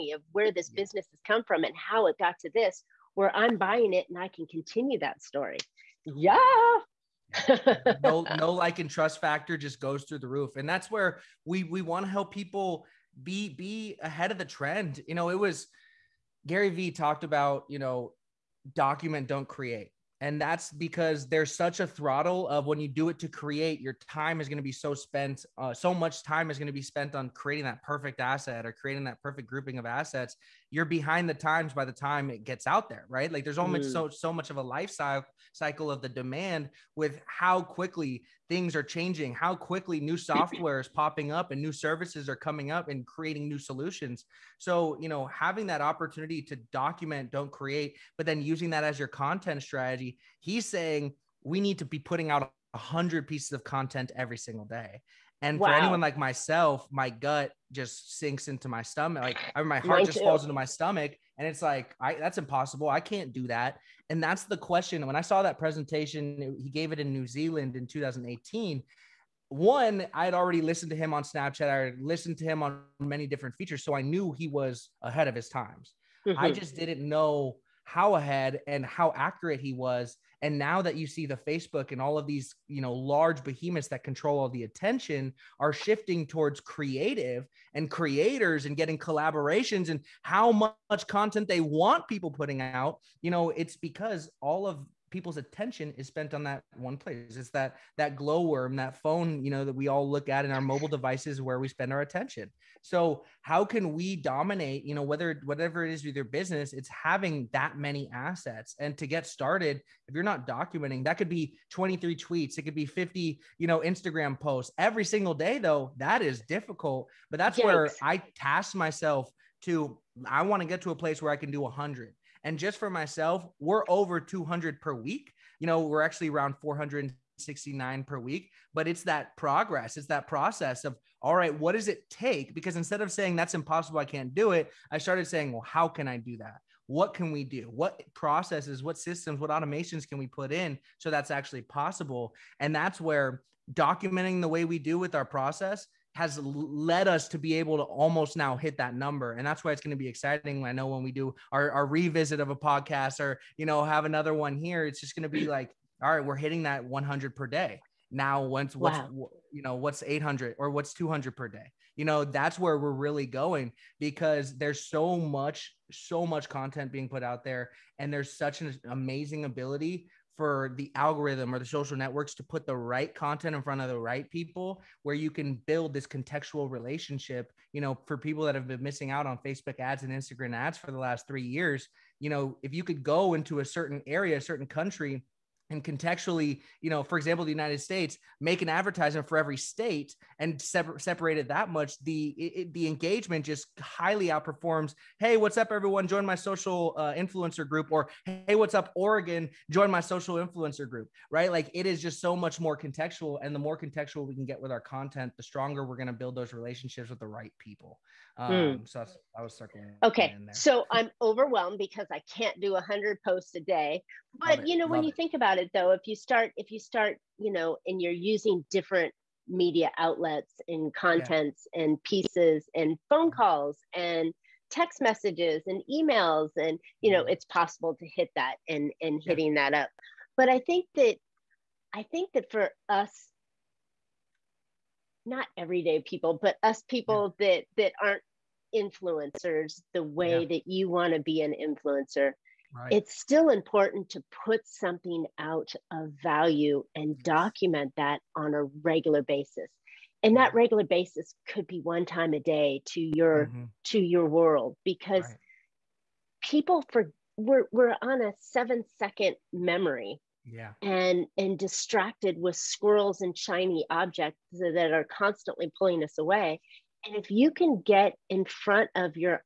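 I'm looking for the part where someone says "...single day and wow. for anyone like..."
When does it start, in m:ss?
0:54.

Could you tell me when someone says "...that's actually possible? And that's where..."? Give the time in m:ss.
2:21.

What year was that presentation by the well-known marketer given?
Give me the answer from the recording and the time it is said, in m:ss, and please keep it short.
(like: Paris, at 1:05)
2018, at 1:07.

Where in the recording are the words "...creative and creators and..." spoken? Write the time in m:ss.
1:26.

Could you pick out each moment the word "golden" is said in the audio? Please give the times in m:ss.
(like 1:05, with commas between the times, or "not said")
not said.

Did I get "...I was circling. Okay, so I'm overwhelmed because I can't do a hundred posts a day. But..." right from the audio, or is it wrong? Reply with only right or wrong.
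right.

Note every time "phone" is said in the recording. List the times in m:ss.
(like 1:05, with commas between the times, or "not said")
1:39, 3:43.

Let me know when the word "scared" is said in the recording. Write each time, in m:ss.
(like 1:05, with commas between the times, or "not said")
not said.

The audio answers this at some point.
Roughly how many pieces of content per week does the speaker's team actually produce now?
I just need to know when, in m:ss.
2:06.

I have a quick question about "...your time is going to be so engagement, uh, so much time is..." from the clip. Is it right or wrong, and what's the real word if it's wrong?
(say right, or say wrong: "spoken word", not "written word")
wrong: "spent", not "engagement".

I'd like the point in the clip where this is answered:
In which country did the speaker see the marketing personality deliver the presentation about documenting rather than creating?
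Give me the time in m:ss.
1:07.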